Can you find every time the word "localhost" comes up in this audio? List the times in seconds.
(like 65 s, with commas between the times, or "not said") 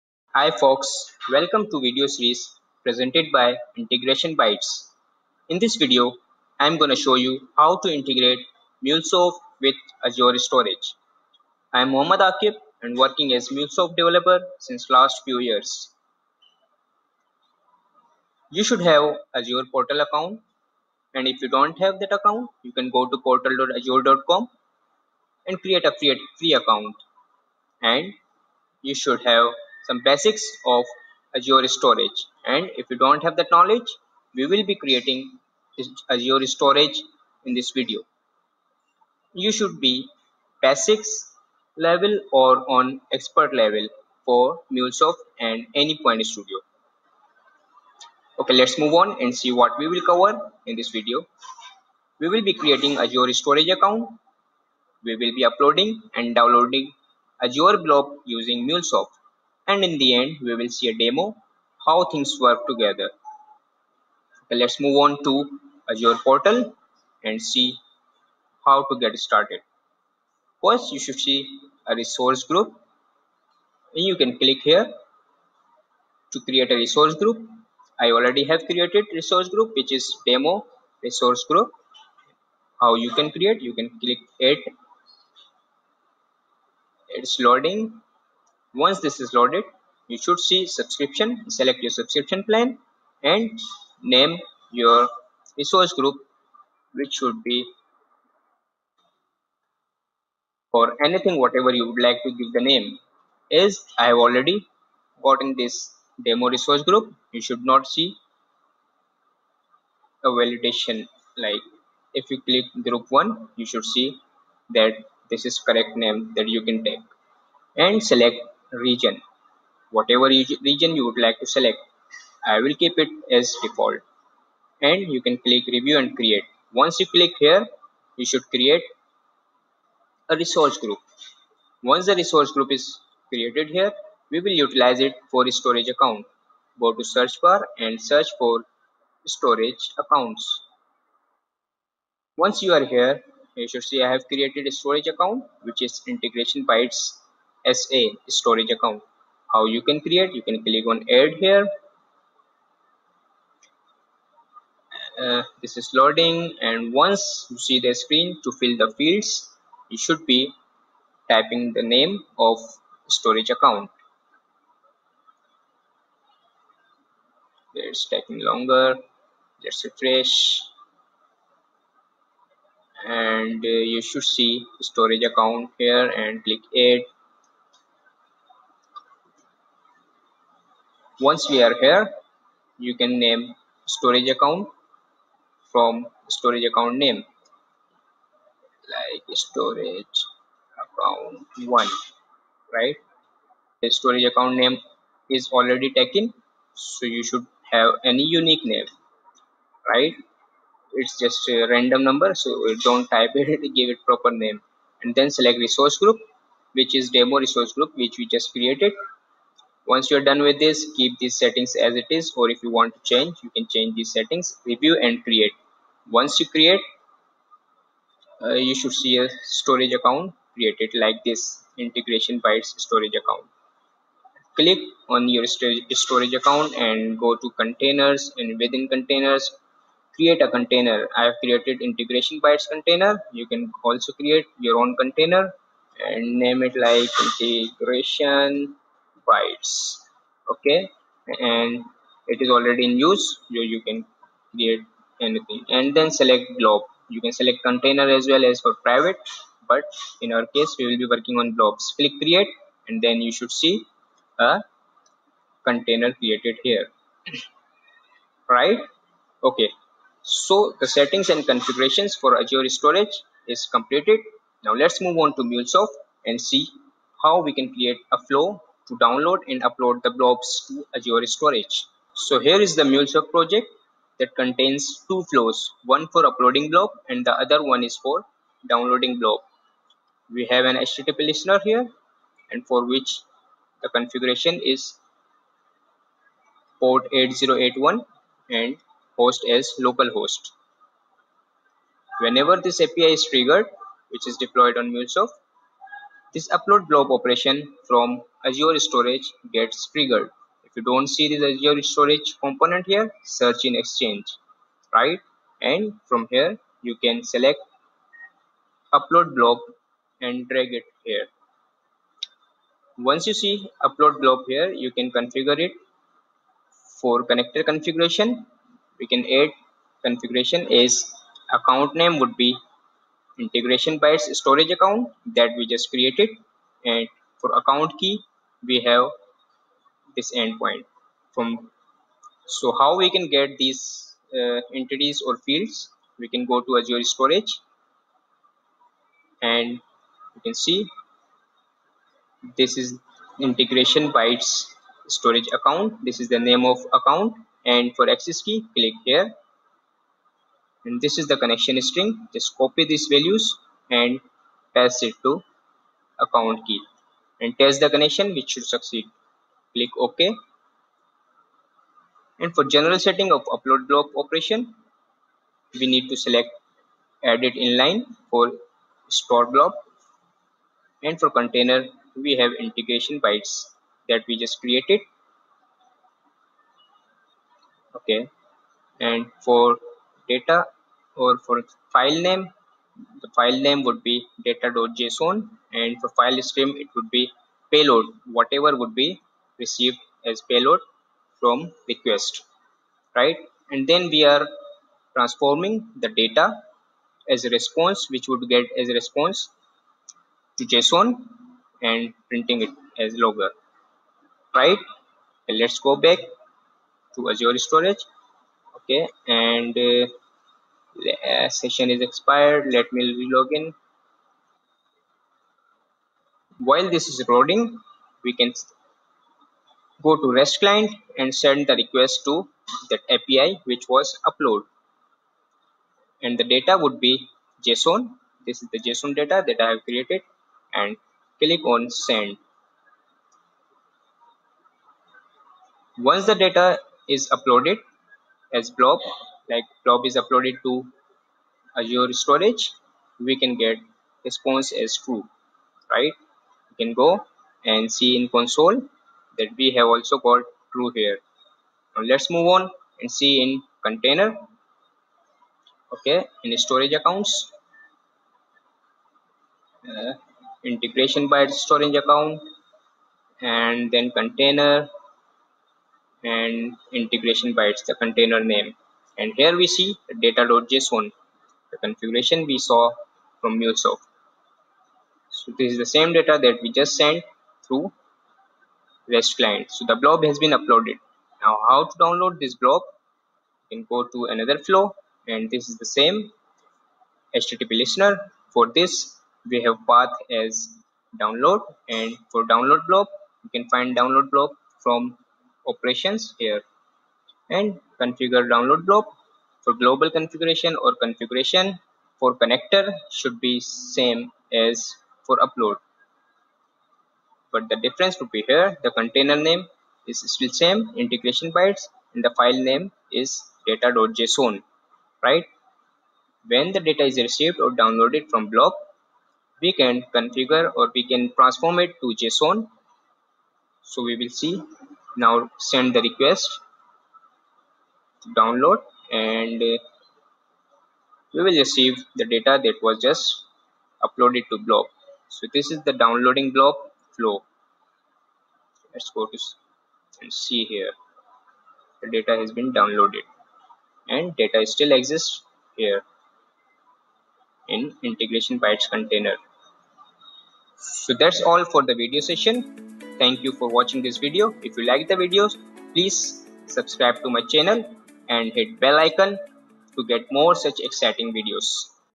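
289 s.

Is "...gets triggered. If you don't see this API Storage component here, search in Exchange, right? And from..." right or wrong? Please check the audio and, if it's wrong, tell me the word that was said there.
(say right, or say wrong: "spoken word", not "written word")
wrong: "Azure", not "API".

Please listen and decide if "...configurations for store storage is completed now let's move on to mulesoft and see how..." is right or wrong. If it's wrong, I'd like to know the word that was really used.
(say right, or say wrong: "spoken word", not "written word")
wrong: "azure", not "store".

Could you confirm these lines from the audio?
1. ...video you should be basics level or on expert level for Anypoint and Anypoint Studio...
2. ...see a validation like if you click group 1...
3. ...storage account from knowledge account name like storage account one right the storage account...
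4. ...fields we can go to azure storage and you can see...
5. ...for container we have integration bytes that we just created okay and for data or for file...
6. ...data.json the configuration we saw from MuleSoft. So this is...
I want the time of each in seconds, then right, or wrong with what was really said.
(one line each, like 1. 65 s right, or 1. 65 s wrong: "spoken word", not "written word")
1. 37 s wrong: "MuleSoft", not "Anypoint"
2. 107 s right
3. 183 s wrong: "storage", not "knowledge"
4. 335 s right
5. 371 s right
6. 470 s right.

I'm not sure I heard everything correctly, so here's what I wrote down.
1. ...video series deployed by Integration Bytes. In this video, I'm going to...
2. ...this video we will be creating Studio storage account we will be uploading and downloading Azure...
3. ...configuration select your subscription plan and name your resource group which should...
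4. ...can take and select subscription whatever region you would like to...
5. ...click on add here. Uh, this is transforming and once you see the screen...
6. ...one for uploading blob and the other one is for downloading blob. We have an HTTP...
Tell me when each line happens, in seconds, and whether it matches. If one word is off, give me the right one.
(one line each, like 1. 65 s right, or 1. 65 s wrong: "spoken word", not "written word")
1. 1 s wrong: "presented", not "deployed"
2. 50 s wrong: "Azure", not "Studio"
3. 90 s wrong: "subscription", not "configuration"
4. 116 s wrong: "region", not "subscription"
5. 150 s wrong: "loading", not "transforming"
6. 275 s right.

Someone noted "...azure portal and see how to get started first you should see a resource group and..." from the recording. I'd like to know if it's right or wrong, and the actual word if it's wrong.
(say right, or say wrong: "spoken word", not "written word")
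right.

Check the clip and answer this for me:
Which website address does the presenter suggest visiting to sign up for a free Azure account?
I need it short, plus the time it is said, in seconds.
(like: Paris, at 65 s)
portal.azure.com, at 23 s.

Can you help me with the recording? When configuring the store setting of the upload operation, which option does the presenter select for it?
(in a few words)
edit inline.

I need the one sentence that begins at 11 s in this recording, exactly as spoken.
I'm Muhammad Aqib and working as MuleSoft developer since last few years.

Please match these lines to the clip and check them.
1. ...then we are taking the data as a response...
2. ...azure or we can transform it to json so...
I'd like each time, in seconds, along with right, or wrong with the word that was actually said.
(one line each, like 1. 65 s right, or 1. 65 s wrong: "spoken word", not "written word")
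1. 393 s wrong: "transforming", not "taking"
2. 520 s wrong: "configure", not "azure".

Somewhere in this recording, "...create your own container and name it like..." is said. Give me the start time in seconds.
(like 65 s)
234 s.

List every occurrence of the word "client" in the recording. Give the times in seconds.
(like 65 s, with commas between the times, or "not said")
420 s, 479 s.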